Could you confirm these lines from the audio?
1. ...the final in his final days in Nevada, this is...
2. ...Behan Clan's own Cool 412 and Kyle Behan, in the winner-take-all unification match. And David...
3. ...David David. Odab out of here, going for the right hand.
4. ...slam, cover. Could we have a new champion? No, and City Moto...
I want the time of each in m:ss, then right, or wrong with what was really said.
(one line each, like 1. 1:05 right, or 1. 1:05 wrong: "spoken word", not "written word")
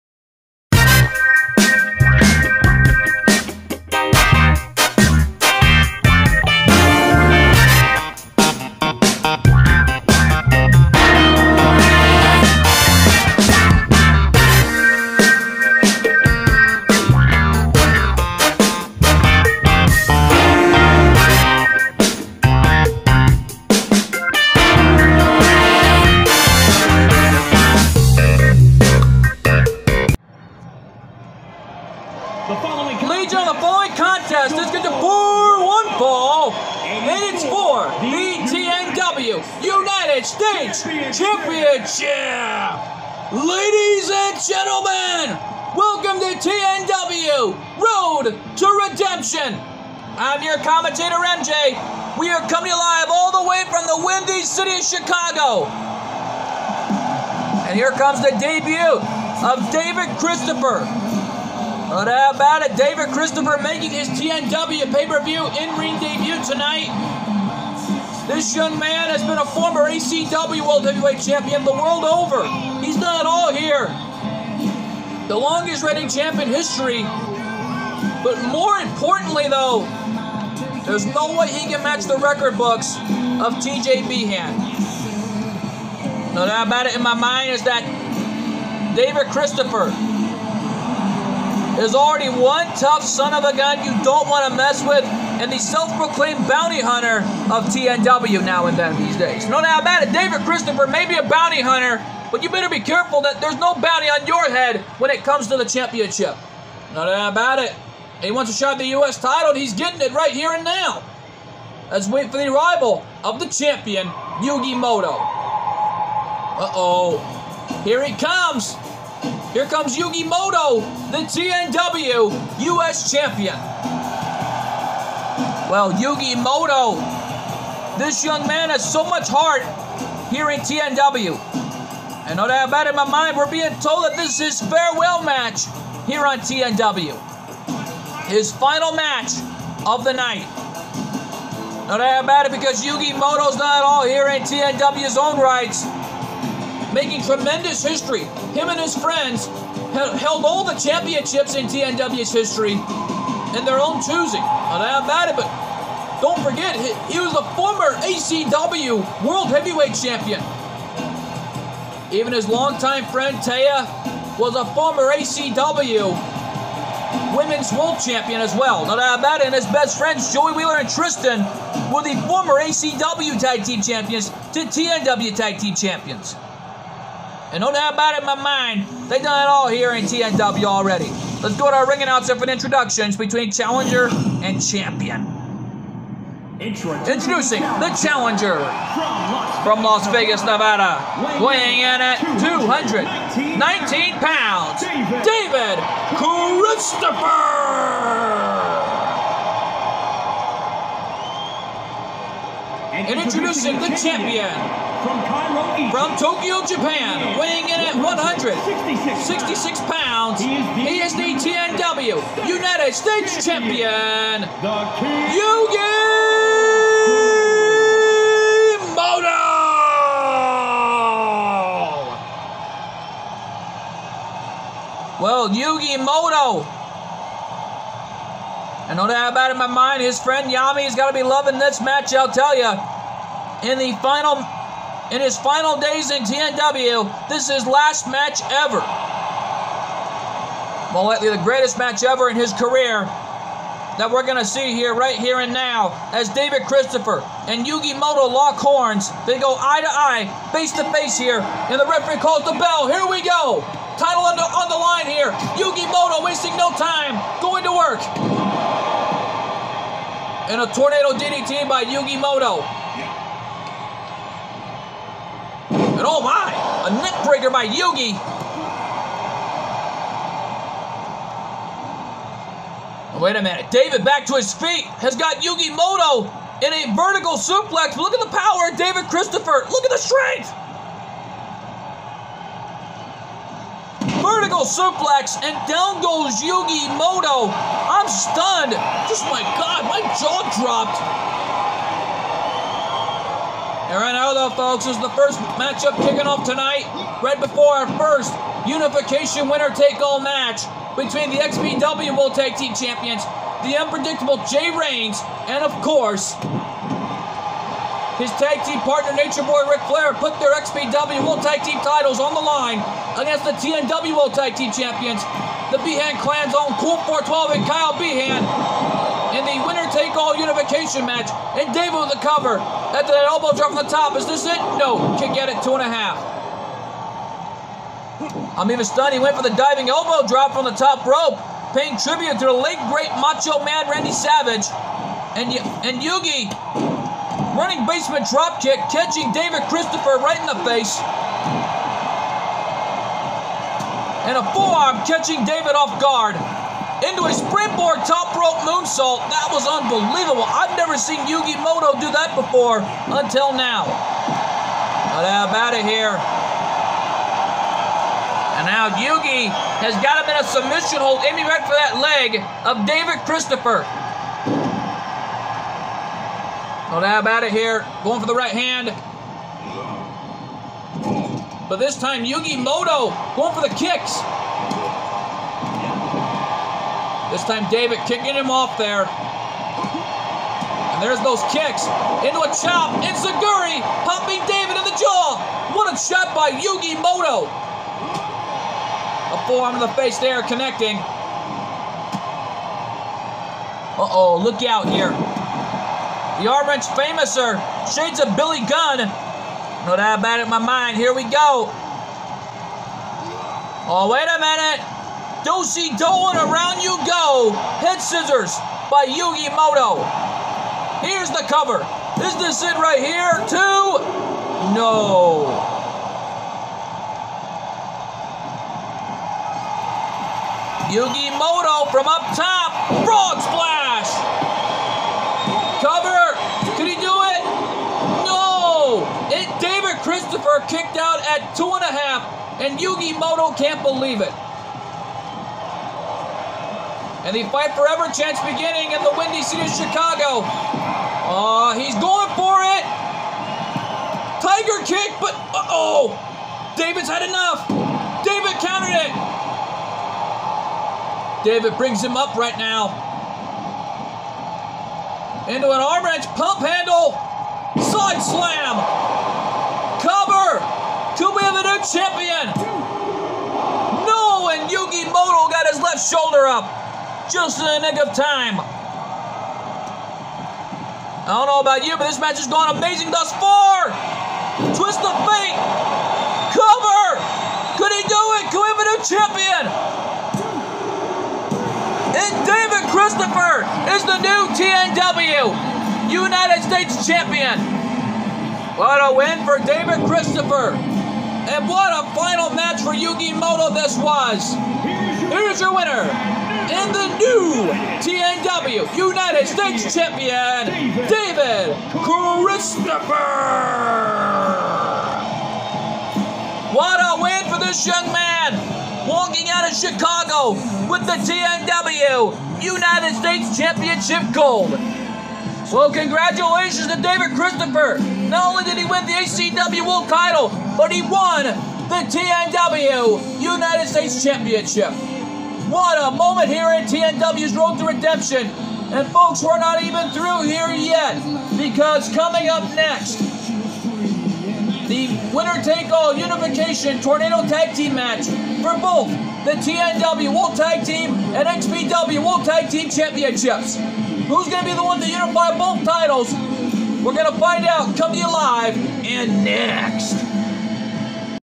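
1. 3:53 wrong: "TNW", not "Nevada"
2. 5:15 right
3. 6:02 wrong: "Christopher", not "David"
4. 7:38 wrong: "Yugi", not "City".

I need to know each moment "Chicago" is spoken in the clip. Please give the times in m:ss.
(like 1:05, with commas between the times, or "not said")
0:54, 7:19, 8:29.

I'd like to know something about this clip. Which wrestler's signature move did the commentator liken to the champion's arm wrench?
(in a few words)
Billy Gunn.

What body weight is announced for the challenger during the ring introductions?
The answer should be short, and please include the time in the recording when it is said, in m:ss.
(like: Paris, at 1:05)
219 pounds, at 3:12.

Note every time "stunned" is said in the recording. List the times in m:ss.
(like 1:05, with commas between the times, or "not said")
4:48, 5:28.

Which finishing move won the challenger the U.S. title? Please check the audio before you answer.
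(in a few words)
Twist of fate.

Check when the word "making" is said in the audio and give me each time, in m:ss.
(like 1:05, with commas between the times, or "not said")
1:03, 2:26.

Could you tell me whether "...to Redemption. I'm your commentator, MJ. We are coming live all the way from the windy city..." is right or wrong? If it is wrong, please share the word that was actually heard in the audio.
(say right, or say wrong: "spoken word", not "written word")
right.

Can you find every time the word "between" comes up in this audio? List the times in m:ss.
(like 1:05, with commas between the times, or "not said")
3:03, 5:00.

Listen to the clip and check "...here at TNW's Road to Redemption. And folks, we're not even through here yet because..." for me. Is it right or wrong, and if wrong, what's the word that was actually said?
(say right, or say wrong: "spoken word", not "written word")
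right.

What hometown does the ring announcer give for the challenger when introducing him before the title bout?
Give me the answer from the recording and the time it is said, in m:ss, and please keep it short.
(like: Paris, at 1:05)
Las Vegas, Nevada, at 3:09.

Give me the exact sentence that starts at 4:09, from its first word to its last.
They go eye to eye, face to face here, and the referee calls the bell.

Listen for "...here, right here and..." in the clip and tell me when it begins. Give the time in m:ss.
4:04.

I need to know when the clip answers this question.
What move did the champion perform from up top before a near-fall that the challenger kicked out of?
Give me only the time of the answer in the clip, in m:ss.
7:03.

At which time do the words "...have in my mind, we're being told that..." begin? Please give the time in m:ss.
2:12.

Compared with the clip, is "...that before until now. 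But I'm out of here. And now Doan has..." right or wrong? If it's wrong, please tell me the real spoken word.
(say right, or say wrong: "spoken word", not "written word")
wrong: "Yugi", not "Doan".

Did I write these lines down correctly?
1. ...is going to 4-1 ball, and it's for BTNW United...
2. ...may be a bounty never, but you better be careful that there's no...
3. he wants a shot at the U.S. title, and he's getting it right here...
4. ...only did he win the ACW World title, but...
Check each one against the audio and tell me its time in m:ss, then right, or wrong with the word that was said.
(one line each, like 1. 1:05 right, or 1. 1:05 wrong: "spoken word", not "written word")
1. 0:34 right
2. 1:40 wrong: "hunter", not "never"
3. 1:48 right
4. 8:38 right.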